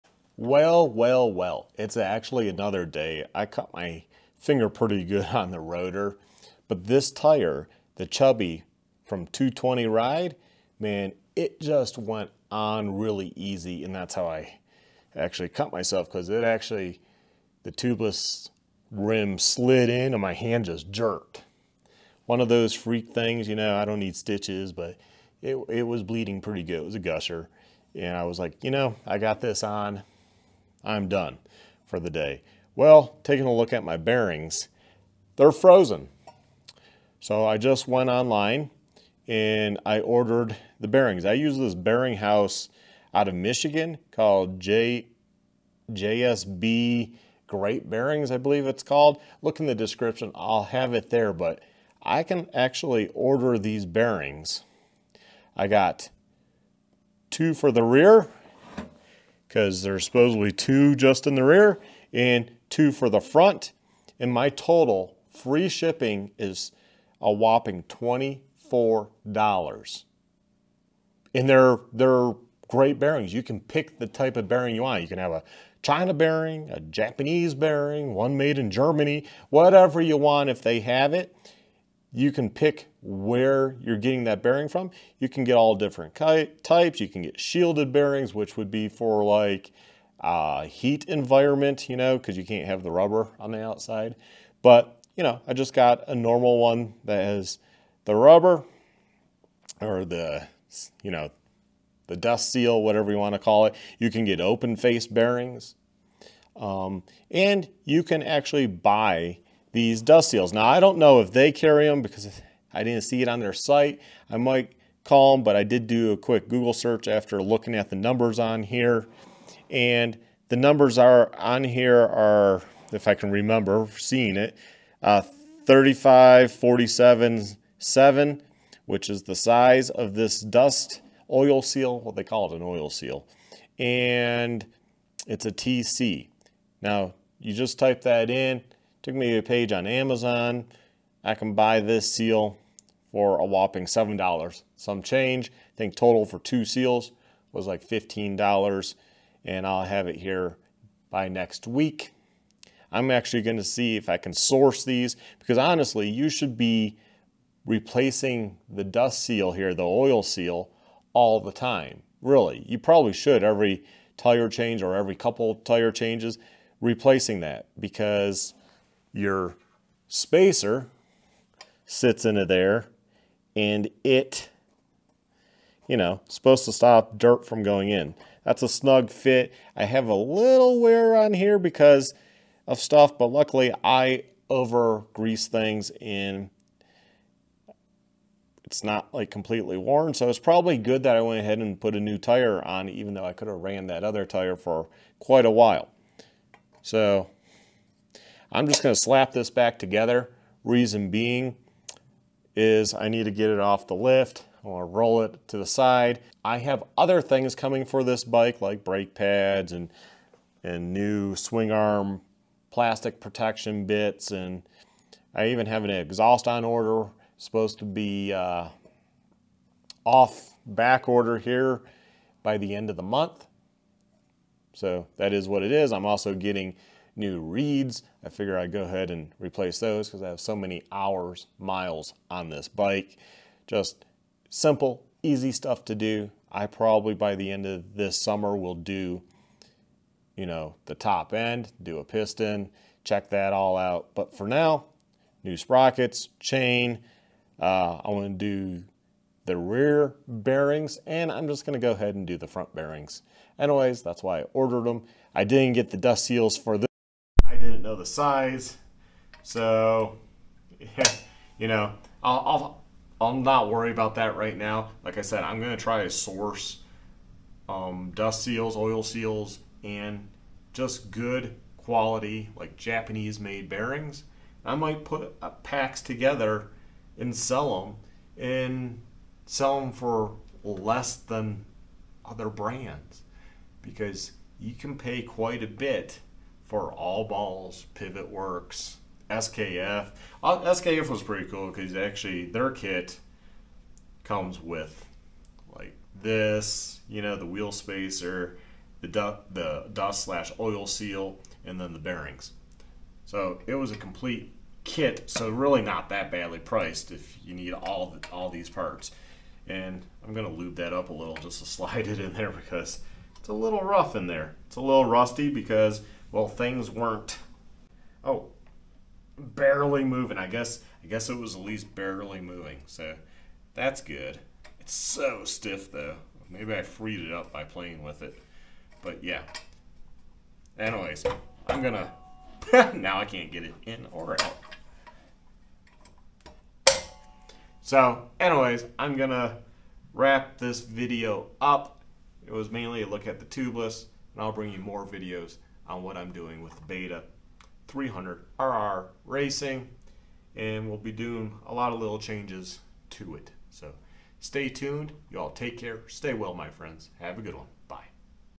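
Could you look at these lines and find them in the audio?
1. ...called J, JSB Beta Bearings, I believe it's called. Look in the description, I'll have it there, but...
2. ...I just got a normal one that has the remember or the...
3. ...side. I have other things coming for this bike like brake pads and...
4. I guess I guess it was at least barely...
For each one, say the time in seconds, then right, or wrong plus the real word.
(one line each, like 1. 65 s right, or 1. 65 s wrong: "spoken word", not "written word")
1. 44 s wrong: "Great", not "Beta"
2. 95 s wrong: "rubber", not "remember"
3. 205 s right
4. 320 s right.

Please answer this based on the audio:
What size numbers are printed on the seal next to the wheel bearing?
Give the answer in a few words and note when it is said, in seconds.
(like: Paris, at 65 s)
35, 47, 7, at 125 s.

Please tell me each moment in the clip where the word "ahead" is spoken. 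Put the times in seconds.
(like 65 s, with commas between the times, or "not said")
191 s, 228 s, 251 s.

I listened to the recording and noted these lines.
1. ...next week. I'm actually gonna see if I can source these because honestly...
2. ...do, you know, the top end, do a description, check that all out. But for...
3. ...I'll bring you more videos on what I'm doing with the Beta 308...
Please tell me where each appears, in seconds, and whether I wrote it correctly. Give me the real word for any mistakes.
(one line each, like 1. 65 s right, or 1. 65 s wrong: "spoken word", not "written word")
1. 151 s right
2. 238 s wrong: "piston", not "description"
3. 344 s wrong: "300", not "308".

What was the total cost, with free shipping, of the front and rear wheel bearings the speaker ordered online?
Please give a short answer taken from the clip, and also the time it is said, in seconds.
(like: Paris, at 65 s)
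$24, at 67 s.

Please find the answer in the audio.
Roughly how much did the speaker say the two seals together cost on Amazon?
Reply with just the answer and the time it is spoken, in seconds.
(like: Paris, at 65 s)
$15, at 147 s.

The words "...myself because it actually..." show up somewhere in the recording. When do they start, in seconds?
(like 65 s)
15 s.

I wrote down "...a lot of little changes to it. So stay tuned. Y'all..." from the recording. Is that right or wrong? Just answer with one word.
right.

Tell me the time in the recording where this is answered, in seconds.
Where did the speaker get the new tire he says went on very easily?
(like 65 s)
9 s.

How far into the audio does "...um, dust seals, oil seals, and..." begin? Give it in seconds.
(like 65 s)
267 s.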